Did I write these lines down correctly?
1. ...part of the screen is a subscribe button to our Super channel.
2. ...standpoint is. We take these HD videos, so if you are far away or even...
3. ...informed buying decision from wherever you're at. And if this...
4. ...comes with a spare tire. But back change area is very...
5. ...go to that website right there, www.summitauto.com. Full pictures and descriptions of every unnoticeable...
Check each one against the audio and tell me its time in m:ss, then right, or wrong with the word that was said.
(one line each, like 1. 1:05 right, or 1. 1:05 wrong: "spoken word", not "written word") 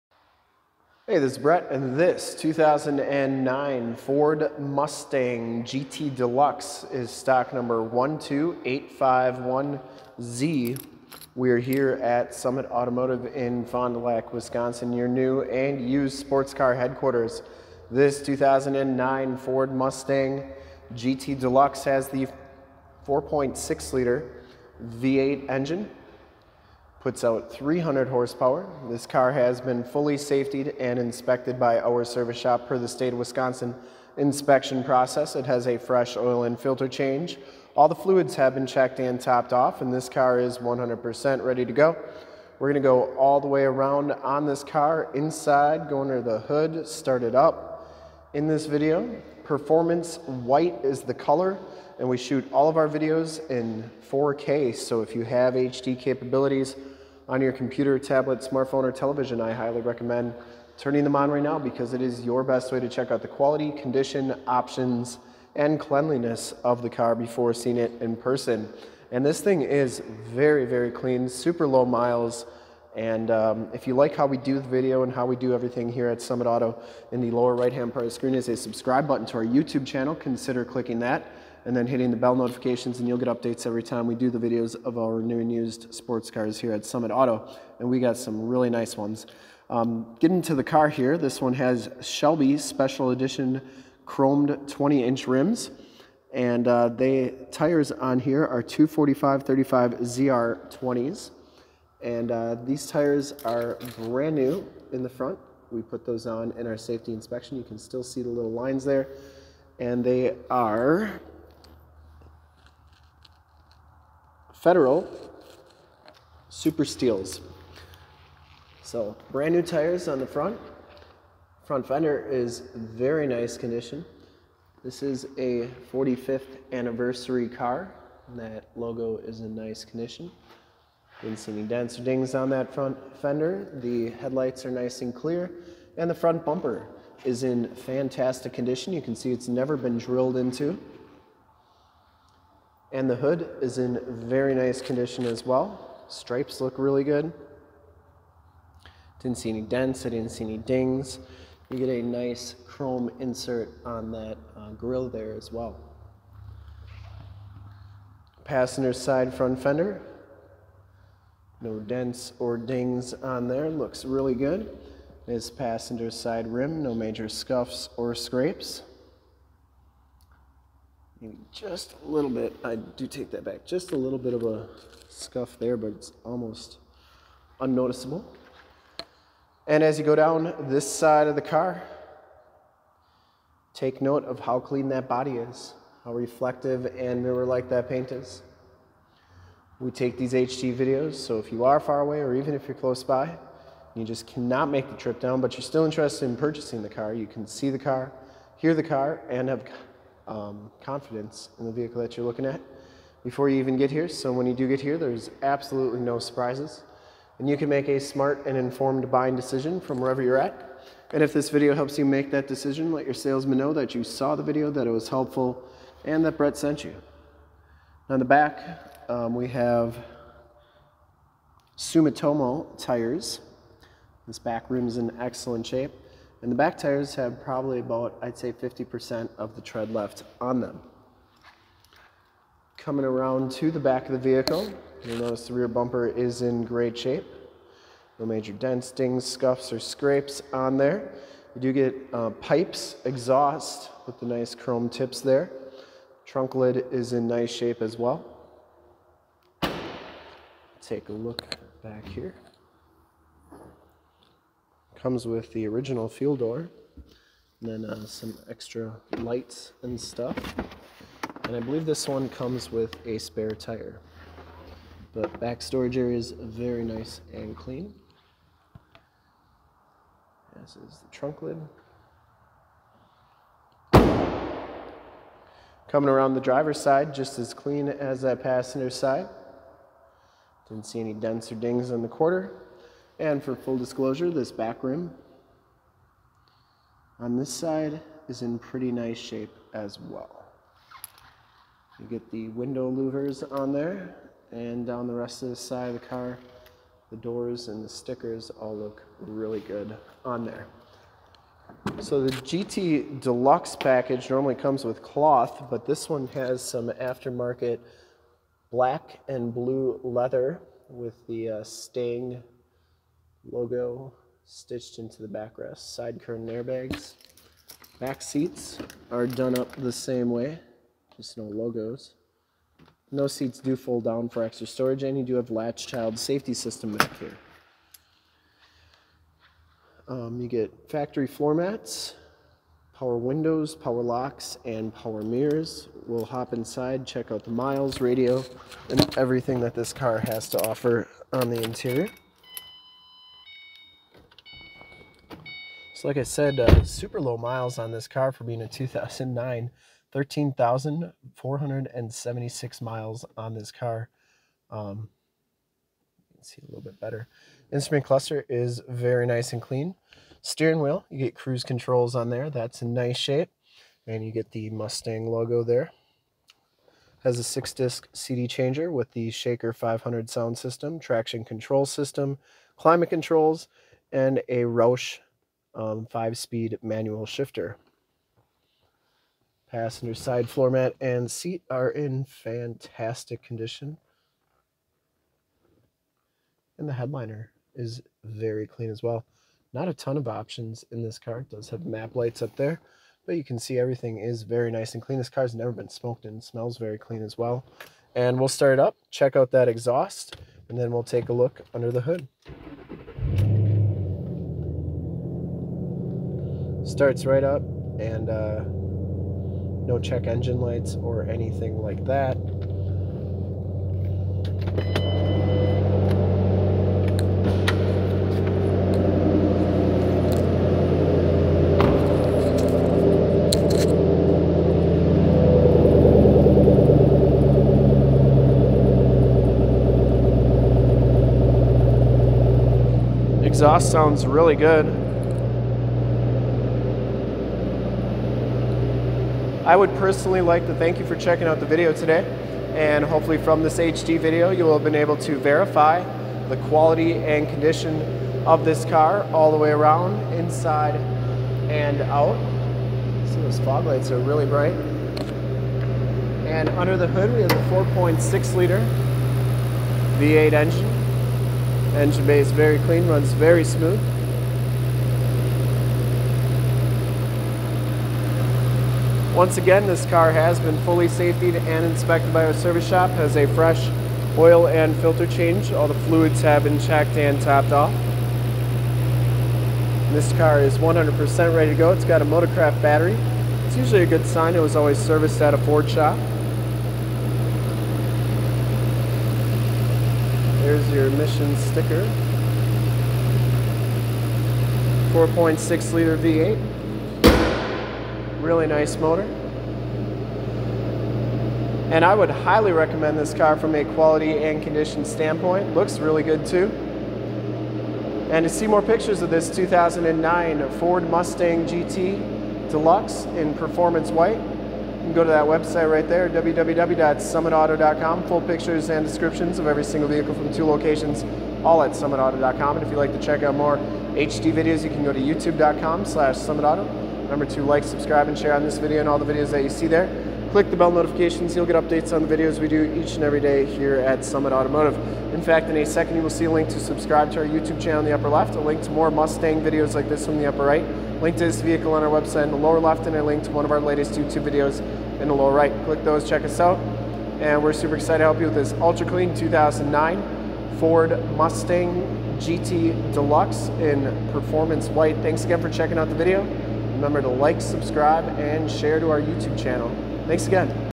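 1. 1:17 wrong: "YouTube", not "Super"
2. 3:07 wrong: "paint", not "standpoint"
3. 3:28 right
4. 4:22 wrong: "storage", not "change"
5. 8:35 wrong: "single", not "unnoticeable".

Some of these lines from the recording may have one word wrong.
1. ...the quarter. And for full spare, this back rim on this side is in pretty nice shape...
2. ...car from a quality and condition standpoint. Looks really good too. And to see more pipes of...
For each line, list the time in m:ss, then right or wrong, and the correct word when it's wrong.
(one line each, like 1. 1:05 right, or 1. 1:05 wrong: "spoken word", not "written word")
1. 4:42 wrong: "disclosure", not "spare"
2. 8:23 wrong: "pictures", not "pipes".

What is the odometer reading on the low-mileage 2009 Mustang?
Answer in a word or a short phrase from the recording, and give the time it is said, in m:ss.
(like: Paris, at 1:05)
13,476 miles, at 5:50.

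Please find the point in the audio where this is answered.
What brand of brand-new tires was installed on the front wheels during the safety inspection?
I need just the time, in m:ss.
1:54.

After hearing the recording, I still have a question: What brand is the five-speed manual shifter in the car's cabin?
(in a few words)
Roush.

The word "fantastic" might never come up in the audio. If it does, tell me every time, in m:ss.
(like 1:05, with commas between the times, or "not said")
2:17, 6:22.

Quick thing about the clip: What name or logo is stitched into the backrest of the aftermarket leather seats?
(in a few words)
Sting.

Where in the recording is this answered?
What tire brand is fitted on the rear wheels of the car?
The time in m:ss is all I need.
3:41.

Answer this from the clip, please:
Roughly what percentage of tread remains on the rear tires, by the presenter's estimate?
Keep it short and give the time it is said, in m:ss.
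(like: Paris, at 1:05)
50%, at 3:48.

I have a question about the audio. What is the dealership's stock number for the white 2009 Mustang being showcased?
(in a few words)
12851Z.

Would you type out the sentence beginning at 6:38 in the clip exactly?
And we'll start up, check out that exhaust, and then we'll take a look under the hood.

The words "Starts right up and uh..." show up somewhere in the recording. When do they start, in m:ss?
6:46.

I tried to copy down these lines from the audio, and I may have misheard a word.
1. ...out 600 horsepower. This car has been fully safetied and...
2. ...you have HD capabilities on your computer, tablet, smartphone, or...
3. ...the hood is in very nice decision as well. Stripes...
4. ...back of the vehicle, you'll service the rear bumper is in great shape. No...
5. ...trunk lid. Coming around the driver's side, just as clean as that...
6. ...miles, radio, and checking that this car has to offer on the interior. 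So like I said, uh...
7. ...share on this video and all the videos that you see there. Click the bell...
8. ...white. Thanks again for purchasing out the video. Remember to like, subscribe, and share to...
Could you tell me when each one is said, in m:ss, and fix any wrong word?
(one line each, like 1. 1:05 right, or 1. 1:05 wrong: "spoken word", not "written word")
1. 0:27 wrong: "300", not "600"
2. 0:55 right
3. 2:23 wrong: "condition", not "decision"
4. 3:53 wrong: "notice", not "service"
5. 4:31 right
6. 5:37 wrong: "everything", not "checking"
7. 8:48 right
8. 9:14 wrong: "checking", not "purchasing".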